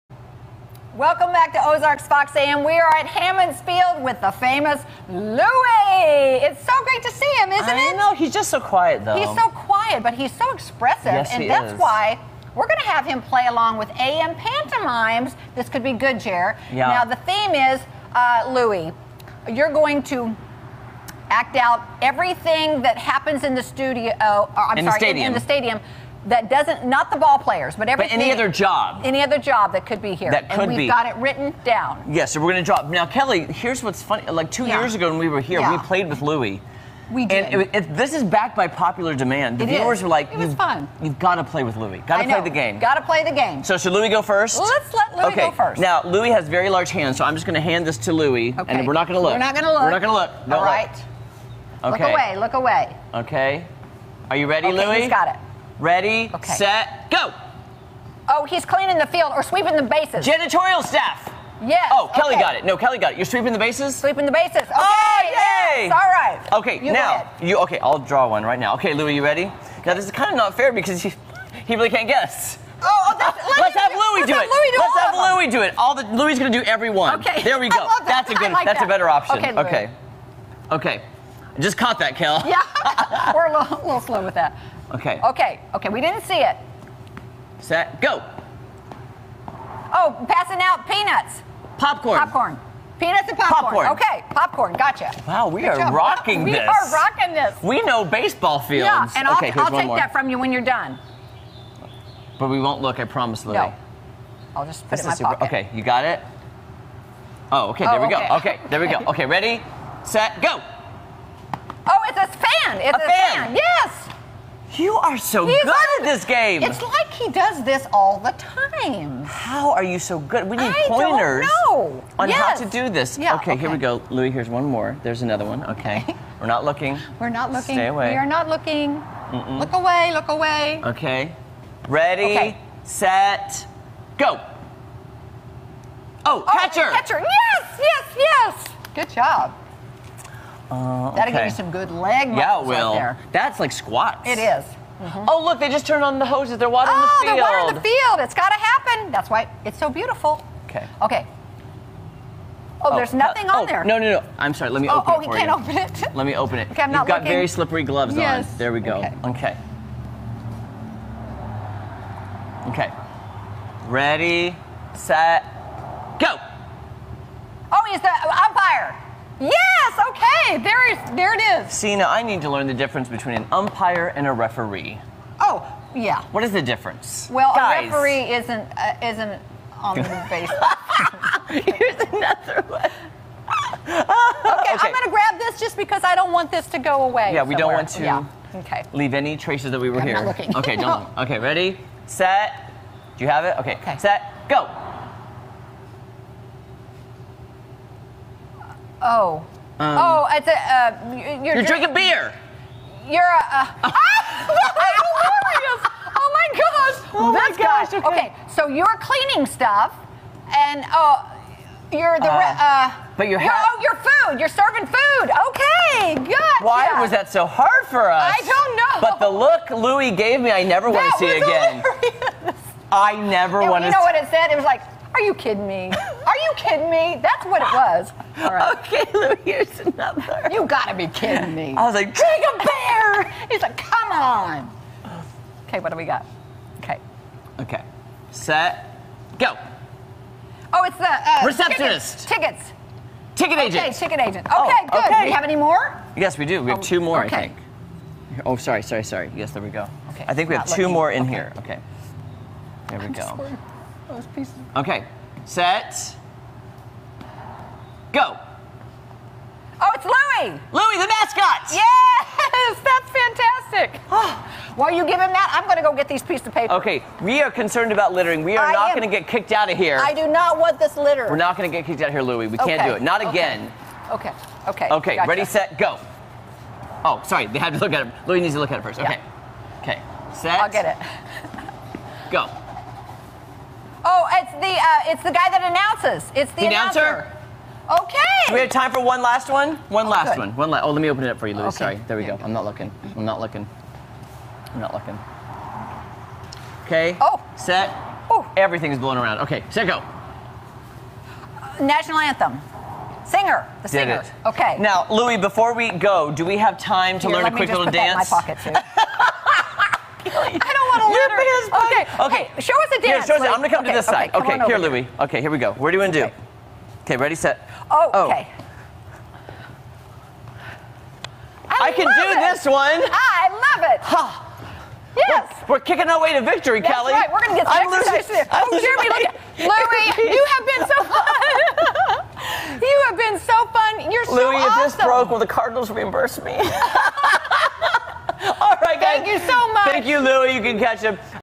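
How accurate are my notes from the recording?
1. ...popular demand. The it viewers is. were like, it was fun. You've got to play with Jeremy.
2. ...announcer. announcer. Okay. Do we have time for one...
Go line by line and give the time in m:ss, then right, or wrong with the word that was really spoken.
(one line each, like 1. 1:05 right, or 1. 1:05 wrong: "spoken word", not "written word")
1. 0:38 wrong: "Louie", not "Jeremy"
2. 4:46 right.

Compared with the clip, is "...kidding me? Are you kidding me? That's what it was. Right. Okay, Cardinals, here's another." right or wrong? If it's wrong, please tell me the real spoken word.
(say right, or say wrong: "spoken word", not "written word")
wrong: "Lou", not "Cardinals".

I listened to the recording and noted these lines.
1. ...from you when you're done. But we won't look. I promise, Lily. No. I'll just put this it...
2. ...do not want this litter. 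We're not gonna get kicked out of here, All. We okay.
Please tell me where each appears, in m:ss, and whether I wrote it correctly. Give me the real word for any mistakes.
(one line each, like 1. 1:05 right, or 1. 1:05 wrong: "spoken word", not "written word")
1. 1:40 right
2. 4:30 wrong: "Louie", not "All".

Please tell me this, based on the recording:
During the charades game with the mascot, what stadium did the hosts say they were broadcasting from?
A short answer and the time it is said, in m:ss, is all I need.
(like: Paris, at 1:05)
Hammons Field, at 0:03.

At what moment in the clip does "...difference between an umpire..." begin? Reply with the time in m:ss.
2:52.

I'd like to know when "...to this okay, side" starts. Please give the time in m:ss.
5:13.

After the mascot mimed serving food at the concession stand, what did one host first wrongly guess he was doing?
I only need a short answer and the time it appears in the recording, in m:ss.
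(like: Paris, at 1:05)
Drinking beer, at 3:21.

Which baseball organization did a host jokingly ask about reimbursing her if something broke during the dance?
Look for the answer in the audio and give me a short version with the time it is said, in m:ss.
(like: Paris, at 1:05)
the Cardinals, at 5:35.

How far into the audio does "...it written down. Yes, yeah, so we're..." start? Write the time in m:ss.
0:31.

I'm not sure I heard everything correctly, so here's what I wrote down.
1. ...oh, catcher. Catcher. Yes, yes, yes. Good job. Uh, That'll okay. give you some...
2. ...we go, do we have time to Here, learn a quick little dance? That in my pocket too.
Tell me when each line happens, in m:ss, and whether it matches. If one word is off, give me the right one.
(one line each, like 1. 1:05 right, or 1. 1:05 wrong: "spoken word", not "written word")
1. 2:16 right
2. 5:05 right.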